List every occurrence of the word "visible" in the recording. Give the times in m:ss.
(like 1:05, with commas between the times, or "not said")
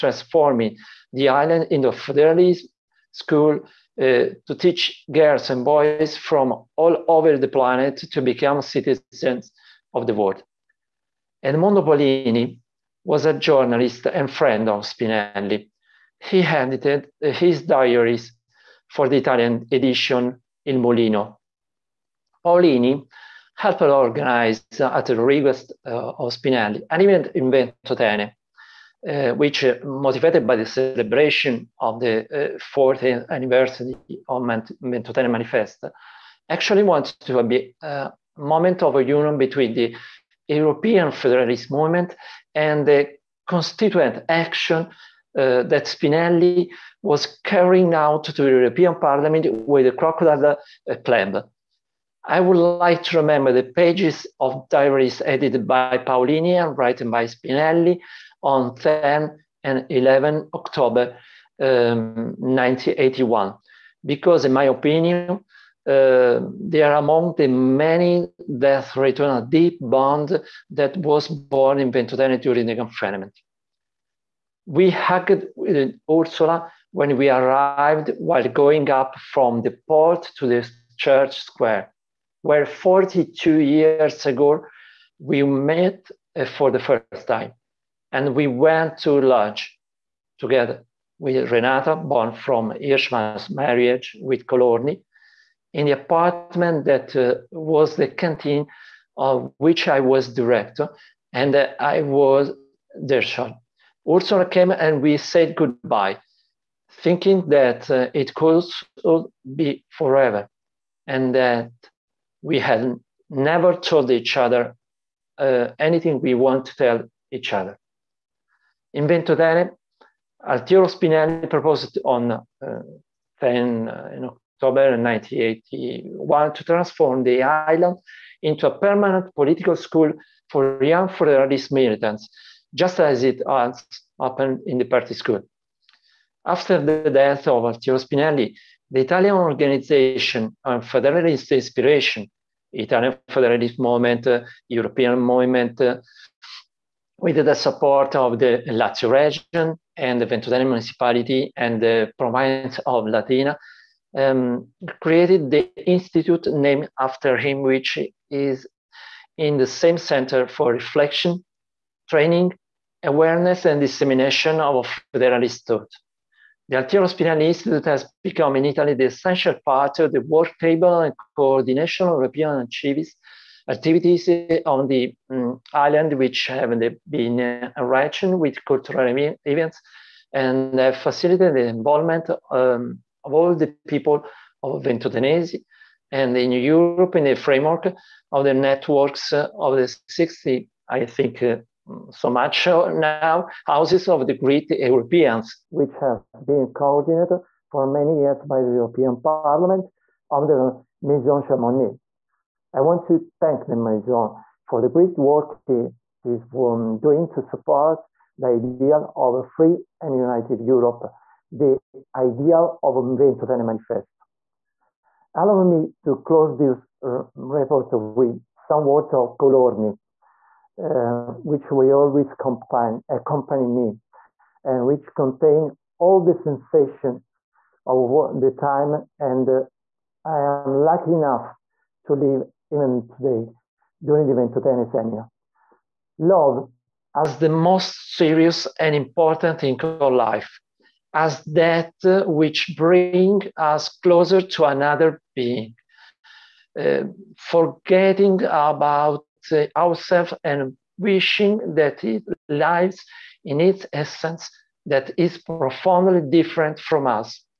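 not said.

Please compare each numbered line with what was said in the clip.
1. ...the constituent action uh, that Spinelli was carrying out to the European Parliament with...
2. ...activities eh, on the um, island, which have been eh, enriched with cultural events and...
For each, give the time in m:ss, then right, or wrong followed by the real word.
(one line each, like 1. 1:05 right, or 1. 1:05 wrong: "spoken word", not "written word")
1. 0:42 right
2. 2:53 right.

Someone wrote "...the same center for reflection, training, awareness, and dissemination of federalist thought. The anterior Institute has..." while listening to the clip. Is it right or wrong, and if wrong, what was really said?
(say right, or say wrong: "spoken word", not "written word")
right.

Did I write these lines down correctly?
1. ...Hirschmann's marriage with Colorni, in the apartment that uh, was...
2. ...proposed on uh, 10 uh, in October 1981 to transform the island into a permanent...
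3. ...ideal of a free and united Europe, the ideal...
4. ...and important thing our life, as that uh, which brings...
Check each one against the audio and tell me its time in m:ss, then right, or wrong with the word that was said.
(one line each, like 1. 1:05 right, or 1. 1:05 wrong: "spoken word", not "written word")
1. 1:32 right
2. 2:01 right
3. 3:28 right
4. 3:58 right.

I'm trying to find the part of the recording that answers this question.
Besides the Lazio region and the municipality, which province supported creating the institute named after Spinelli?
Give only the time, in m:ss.
2:33.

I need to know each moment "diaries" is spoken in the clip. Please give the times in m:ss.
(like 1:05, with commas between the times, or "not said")
0:17, 0:54.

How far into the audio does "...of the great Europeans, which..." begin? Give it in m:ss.
3:14.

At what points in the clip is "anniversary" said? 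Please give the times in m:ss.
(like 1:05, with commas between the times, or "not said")
0:33.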